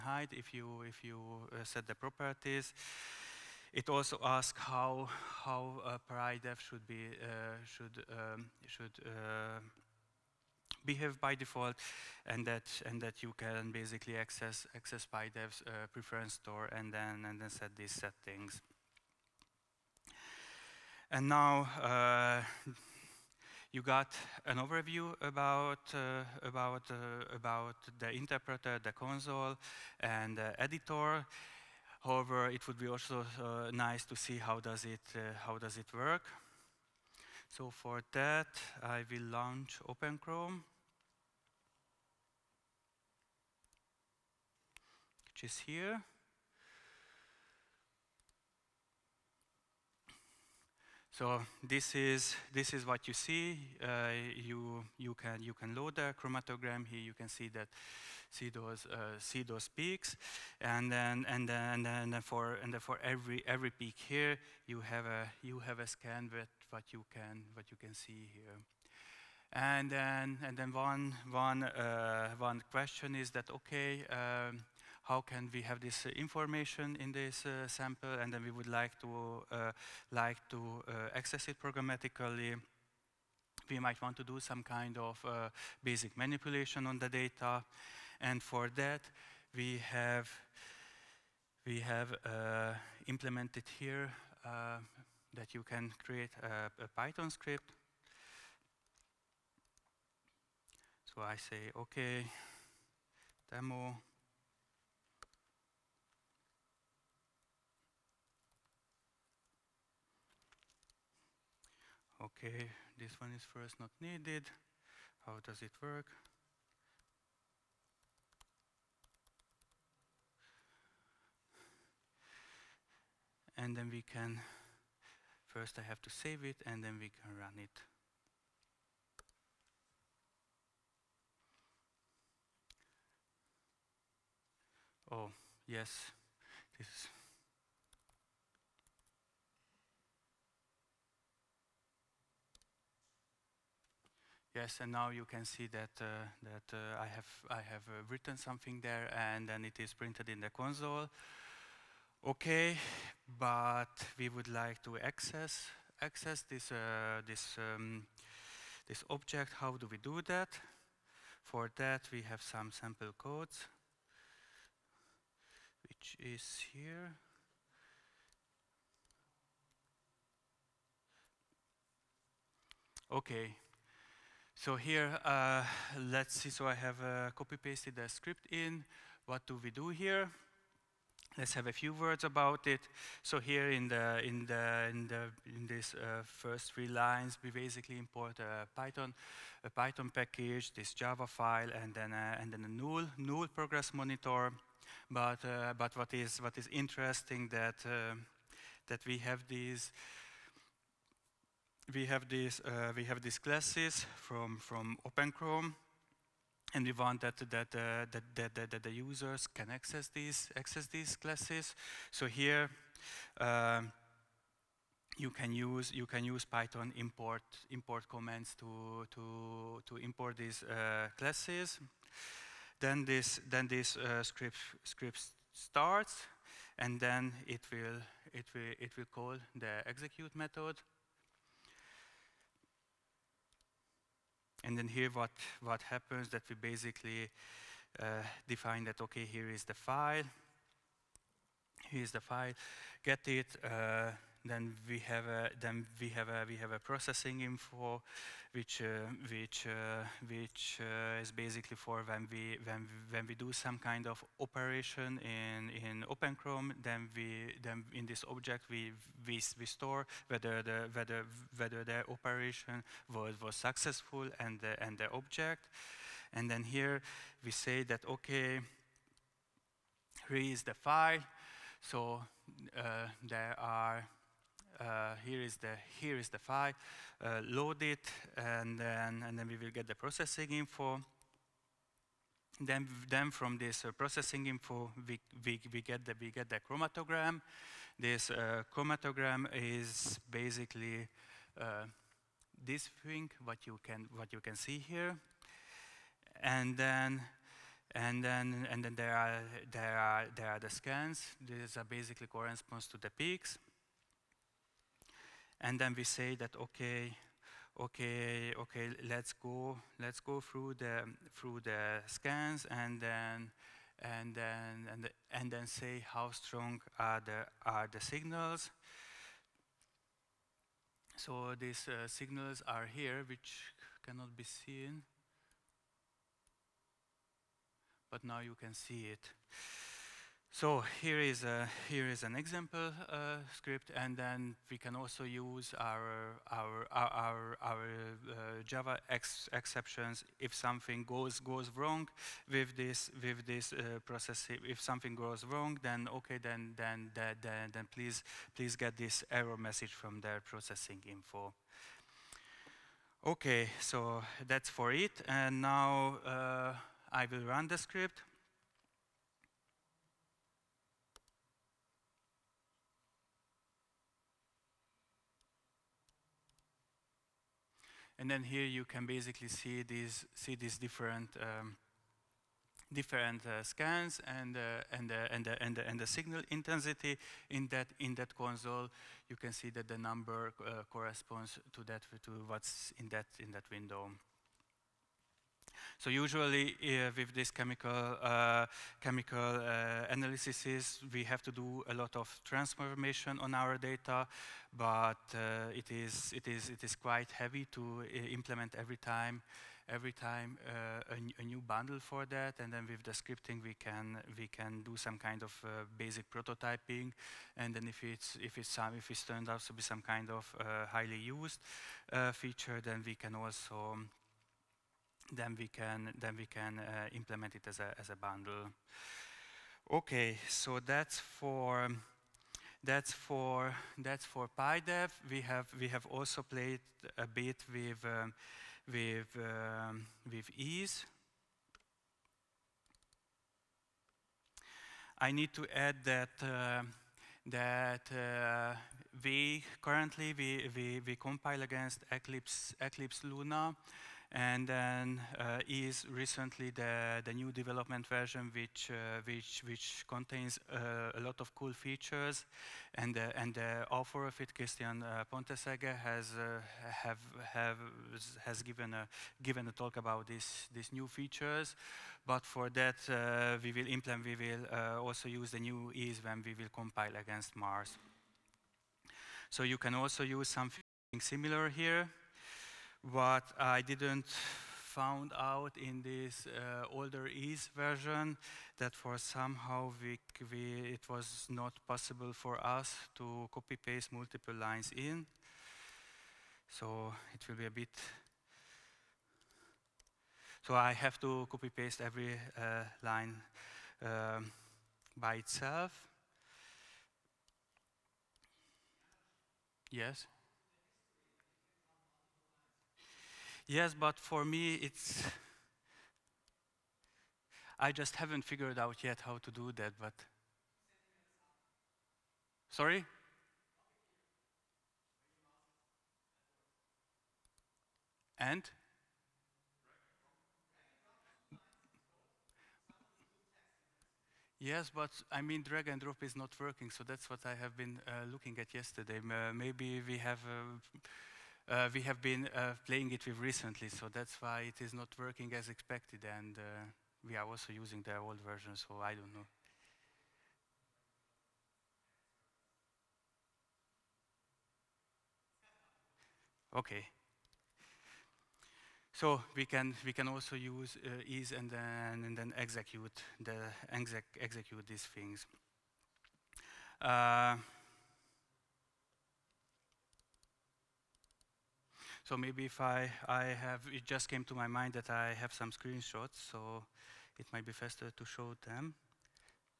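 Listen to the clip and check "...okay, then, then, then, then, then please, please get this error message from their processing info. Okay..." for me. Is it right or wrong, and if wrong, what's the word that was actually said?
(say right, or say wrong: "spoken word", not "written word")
right.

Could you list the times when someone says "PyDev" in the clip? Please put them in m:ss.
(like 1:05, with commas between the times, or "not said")
0:06, 0:15, 7:04.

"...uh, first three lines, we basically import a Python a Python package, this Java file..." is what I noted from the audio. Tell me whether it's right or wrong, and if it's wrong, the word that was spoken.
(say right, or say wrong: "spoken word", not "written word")
right.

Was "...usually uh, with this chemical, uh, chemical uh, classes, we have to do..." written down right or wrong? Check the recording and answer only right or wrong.
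wrong.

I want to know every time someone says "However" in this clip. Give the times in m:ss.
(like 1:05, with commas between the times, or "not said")
0:32.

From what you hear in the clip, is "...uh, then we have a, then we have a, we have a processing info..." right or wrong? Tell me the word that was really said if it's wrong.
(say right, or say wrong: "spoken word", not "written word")
right.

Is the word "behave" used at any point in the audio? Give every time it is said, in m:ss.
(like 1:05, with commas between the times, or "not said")
0:10.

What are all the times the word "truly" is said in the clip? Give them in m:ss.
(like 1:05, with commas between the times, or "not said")
not said.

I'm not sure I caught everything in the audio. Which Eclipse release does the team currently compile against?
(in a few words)
Eclipse Luna.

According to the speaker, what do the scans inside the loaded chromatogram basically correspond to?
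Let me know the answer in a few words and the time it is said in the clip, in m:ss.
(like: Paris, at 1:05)
the peaks, at 5:01.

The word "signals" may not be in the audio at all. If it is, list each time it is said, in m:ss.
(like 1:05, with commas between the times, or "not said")
5:18, 5:22, 6:16.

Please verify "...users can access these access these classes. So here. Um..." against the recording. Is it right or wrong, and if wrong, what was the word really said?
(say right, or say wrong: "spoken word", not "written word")
right.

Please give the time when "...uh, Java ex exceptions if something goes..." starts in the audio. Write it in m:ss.
5:38.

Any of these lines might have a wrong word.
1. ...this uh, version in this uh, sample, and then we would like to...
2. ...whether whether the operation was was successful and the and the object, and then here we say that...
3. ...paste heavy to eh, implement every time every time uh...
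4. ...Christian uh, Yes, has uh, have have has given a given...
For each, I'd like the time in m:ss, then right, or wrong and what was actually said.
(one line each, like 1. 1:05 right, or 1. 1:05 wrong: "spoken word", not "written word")
1. 1:15 wrong: "information", not "version"
2. 4:20 right
3. 6:36 wrong: "quite", not "paste"
4. 7:34 wrong: "Pontesegger", not "Yes".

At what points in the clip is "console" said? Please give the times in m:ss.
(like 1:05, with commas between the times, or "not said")
0:28, 2:30, 6:18.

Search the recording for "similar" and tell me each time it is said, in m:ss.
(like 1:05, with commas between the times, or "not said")
7:51.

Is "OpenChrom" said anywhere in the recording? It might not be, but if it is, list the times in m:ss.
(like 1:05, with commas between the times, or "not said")
0:39, 3:25, 4:16.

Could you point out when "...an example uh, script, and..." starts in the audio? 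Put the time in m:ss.
5:32.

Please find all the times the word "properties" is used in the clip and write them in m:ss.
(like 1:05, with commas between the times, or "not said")
0:01.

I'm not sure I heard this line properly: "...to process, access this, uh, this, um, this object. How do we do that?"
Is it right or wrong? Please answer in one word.
wrong.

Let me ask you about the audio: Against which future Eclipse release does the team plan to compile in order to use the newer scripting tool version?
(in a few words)
Mars.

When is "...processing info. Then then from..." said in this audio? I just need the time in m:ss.
4:39.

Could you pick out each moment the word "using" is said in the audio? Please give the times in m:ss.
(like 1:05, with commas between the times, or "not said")
8:57.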